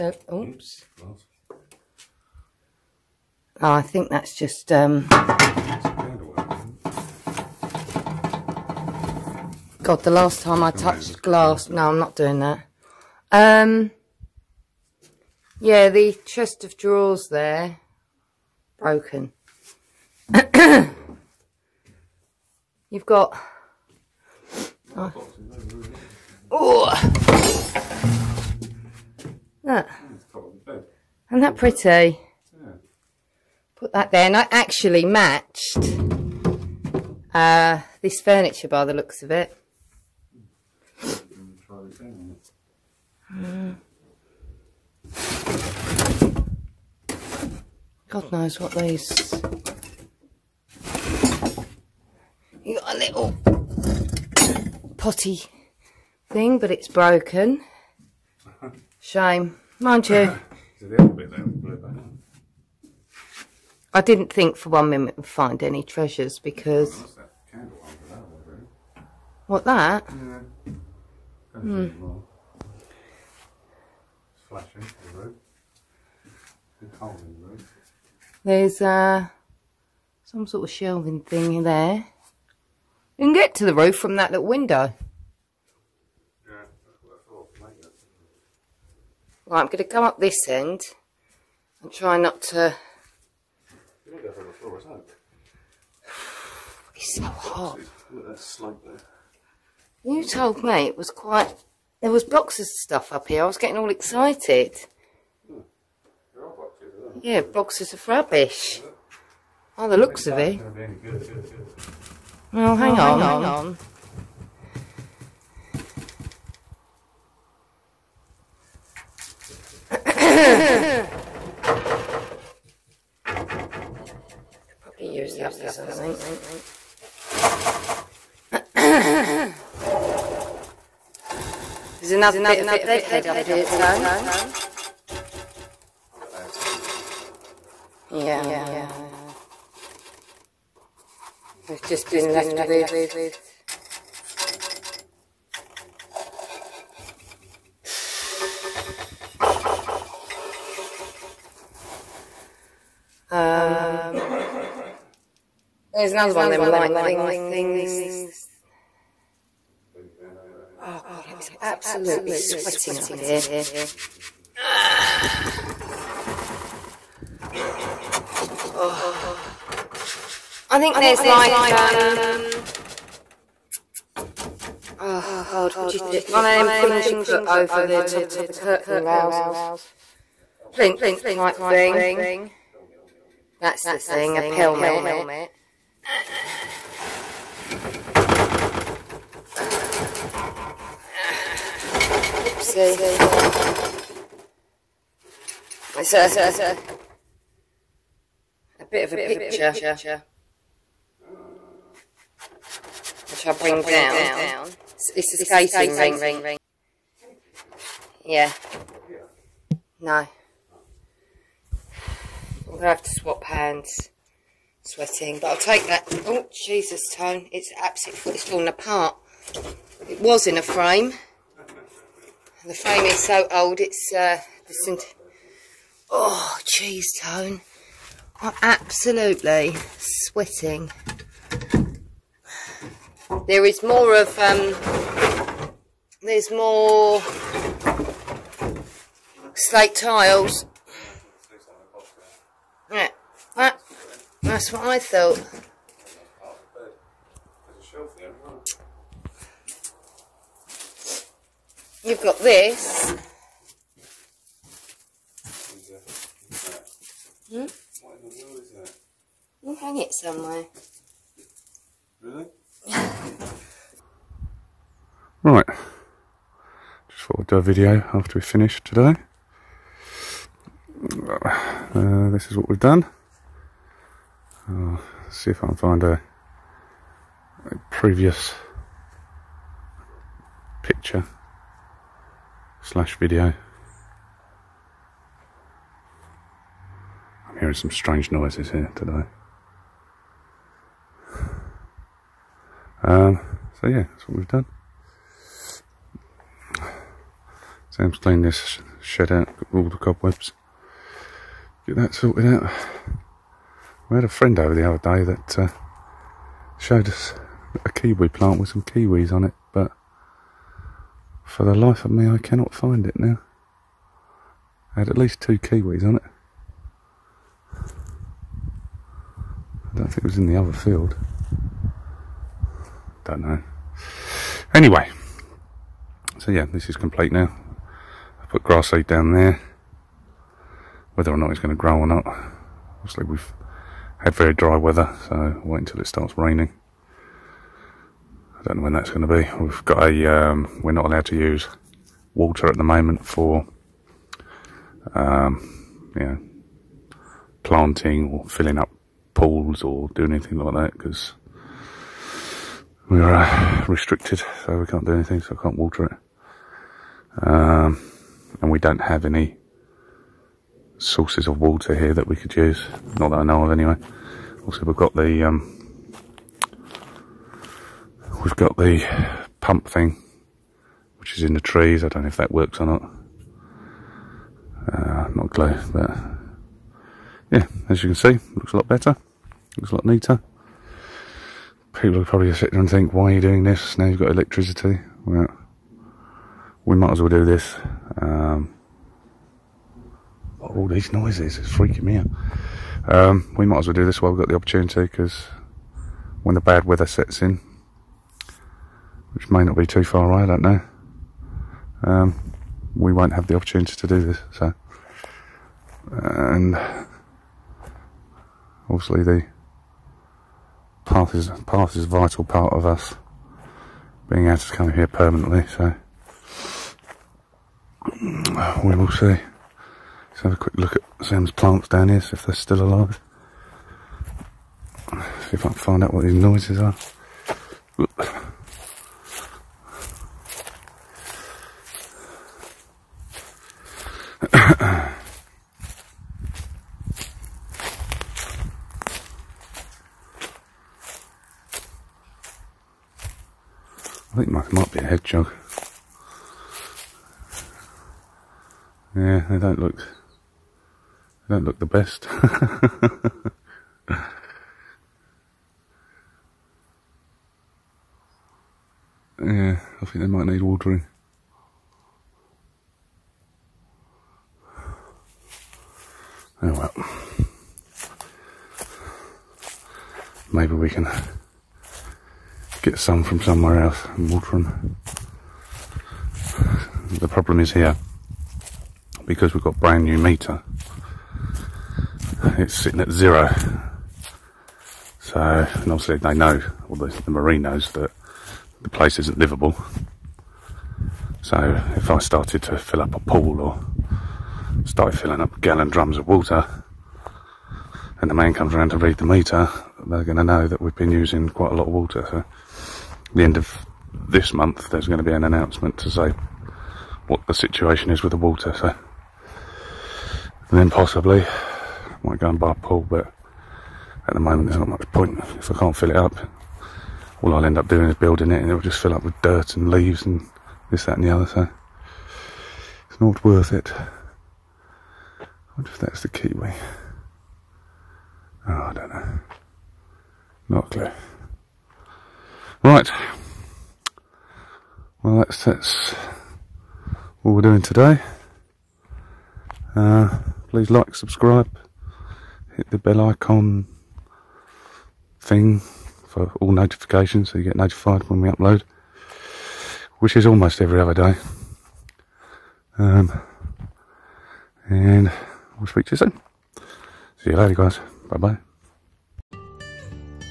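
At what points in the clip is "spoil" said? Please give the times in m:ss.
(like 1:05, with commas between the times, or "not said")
not said.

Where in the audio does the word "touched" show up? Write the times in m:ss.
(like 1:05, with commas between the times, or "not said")
0:10.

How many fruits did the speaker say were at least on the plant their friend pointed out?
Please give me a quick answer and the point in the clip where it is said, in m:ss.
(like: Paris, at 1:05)
2, at 5:15.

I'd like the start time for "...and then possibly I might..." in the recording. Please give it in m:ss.
8:30.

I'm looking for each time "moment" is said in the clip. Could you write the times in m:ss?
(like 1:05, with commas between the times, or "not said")
5:42, 8:34.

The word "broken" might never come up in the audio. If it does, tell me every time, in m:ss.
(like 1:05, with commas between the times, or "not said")
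0:18, 0:56.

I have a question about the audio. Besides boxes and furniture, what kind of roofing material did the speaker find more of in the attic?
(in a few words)
slate tiles.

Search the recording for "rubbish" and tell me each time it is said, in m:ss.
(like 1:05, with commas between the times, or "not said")
1:48.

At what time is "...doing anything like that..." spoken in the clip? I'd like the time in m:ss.
5:50.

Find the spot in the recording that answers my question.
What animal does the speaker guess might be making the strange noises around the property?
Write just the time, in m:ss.
7:25.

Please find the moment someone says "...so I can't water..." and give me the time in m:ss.
5:55.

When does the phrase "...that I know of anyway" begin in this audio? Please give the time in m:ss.
6:03.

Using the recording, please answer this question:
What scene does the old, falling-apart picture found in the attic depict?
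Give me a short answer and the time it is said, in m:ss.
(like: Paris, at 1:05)
a skating rink, at 3:25.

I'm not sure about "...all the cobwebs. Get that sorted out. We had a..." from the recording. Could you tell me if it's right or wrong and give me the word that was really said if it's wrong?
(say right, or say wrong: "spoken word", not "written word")
right.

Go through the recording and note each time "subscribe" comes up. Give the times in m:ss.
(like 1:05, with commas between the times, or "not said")
9:01.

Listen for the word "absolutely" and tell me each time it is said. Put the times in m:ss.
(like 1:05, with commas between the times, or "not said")
2:41, 3:37, 3:48.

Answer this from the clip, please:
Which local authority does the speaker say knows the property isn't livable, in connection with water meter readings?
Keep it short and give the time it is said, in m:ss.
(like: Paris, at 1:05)
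the mairie, at 8:07.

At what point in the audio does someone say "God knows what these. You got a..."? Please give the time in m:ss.
0:48.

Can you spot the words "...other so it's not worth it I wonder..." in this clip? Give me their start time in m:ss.
8:41.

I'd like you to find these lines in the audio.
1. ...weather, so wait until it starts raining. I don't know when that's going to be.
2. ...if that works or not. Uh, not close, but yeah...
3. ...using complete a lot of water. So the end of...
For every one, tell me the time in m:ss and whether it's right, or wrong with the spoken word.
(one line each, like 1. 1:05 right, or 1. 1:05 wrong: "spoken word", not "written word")
1. 5:34 right
2. 6:12 right
3. 8:21 wrong: "quite", not "complete".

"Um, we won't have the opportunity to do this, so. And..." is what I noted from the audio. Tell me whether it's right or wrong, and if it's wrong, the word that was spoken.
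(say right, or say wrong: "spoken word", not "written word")
right.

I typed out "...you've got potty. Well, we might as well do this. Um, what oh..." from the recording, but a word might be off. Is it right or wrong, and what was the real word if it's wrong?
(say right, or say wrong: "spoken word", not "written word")
wrong: "electricity", not "potty".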